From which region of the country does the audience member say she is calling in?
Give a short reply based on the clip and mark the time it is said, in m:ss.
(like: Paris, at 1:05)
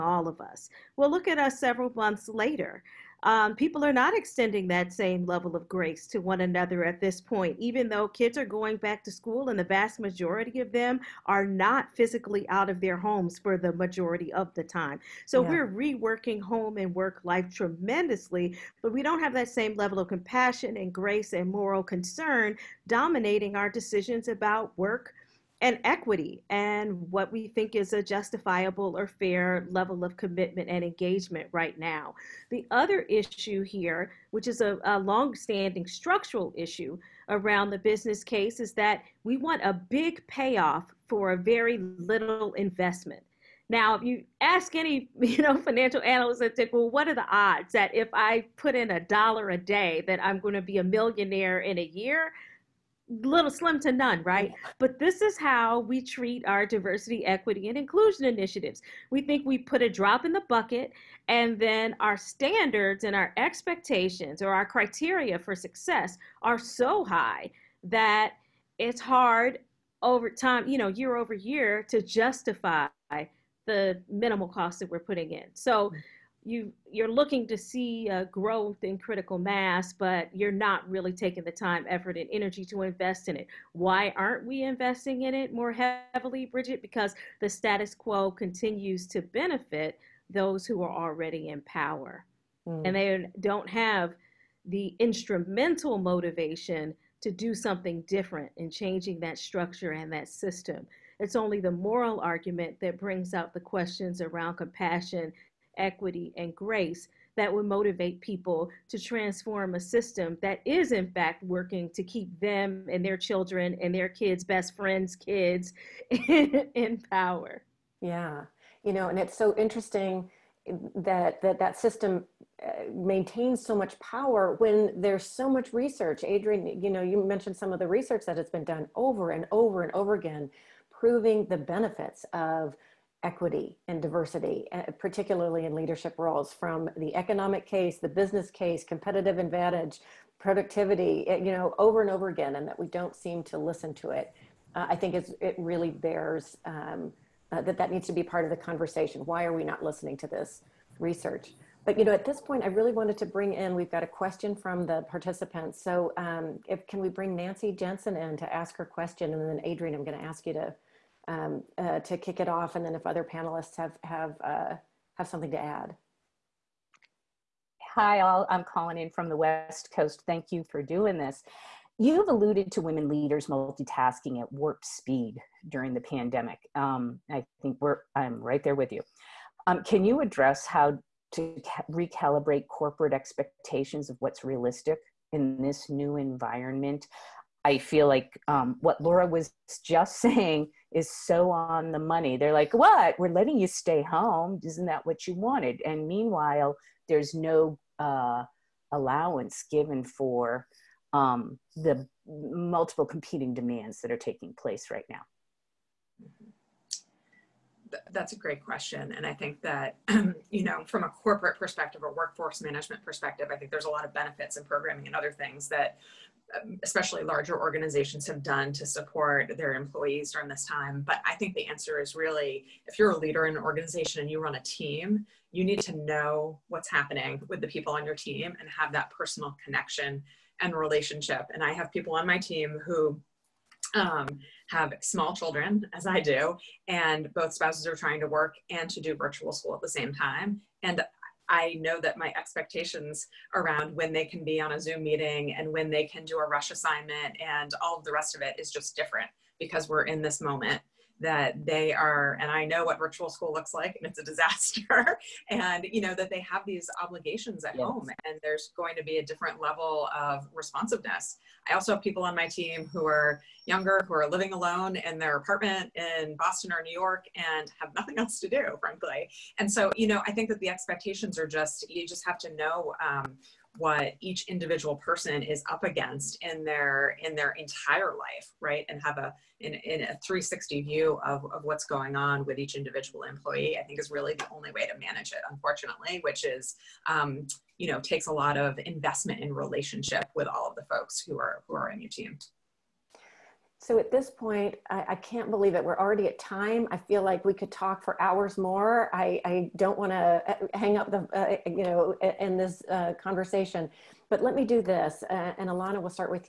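West Coast, at 2:49.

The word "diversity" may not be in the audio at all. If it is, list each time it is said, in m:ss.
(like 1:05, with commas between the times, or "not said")
0:56, 2:13.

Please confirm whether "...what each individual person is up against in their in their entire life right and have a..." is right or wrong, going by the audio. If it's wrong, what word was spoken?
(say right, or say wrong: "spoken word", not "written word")
right.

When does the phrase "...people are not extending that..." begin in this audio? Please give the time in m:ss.
0:03.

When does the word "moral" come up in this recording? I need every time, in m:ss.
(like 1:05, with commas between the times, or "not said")
0:21, 1:41.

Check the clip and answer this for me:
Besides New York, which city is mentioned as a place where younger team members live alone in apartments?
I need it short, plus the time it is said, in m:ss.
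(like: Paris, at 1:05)
Boston, at 4:26.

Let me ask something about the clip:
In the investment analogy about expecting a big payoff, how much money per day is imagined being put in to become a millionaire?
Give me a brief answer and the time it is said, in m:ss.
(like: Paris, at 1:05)
a dollar, at 0:48.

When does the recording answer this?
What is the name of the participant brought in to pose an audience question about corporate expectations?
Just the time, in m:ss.
2:37.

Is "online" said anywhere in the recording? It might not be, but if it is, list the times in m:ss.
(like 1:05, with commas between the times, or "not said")
not said.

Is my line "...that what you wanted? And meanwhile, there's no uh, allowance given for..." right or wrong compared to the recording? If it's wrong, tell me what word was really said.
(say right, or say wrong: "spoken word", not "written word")
right.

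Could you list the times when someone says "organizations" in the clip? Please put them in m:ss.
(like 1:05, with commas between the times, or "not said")
3:37, 3:43.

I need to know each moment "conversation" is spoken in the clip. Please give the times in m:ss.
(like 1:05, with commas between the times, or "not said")
2:28, 5:03.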